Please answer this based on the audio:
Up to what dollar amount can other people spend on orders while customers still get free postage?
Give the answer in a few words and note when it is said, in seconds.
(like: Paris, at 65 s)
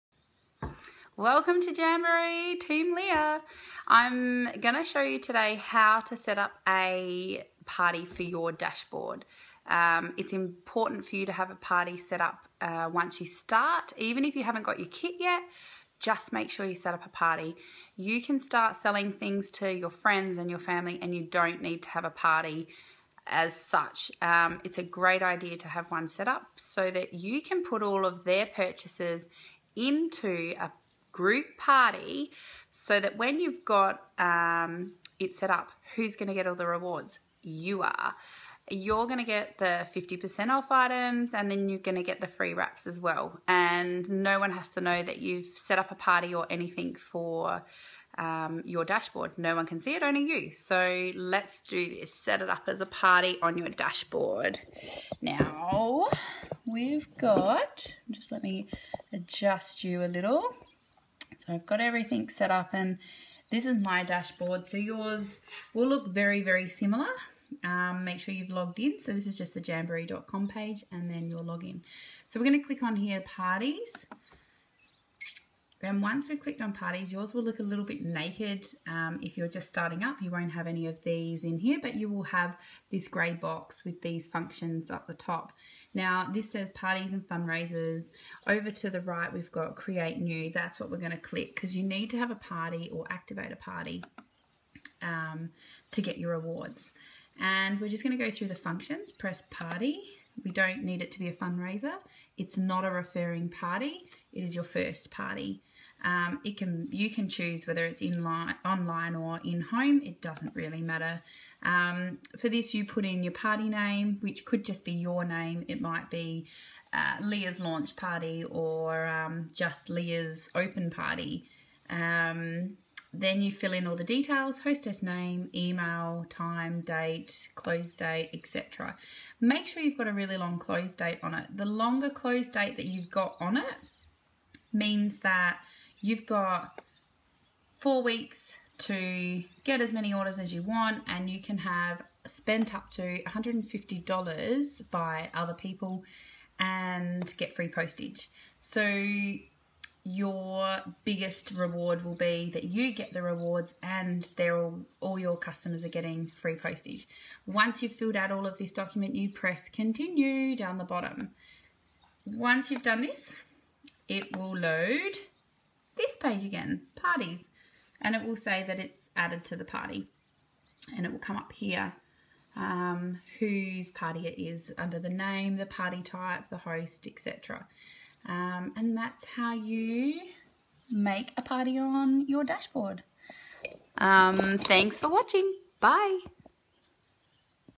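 $150, at 143 s.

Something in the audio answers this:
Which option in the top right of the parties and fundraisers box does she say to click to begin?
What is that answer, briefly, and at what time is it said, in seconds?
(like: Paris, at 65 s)
create new, at 89 s.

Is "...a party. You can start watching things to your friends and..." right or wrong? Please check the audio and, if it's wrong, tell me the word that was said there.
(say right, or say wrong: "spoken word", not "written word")
wrong: "selling", not "watching".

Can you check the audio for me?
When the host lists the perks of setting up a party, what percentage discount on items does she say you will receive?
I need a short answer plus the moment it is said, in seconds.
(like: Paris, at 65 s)
50%, at 39 s.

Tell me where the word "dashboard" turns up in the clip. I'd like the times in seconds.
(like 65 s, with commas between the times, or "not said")
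8 s, 48 s, 53 s, 64 s, 182 s.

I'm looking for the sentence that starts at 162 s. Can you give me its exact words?
Once you've done this, it will load this page again, parties, and it will say that it's added to the party.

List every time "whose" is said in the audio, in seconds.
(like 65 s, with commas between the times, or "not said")
173 s.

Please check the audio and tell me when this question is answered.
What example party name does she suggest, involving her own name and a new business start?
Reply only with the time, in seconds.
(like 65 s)
117 s.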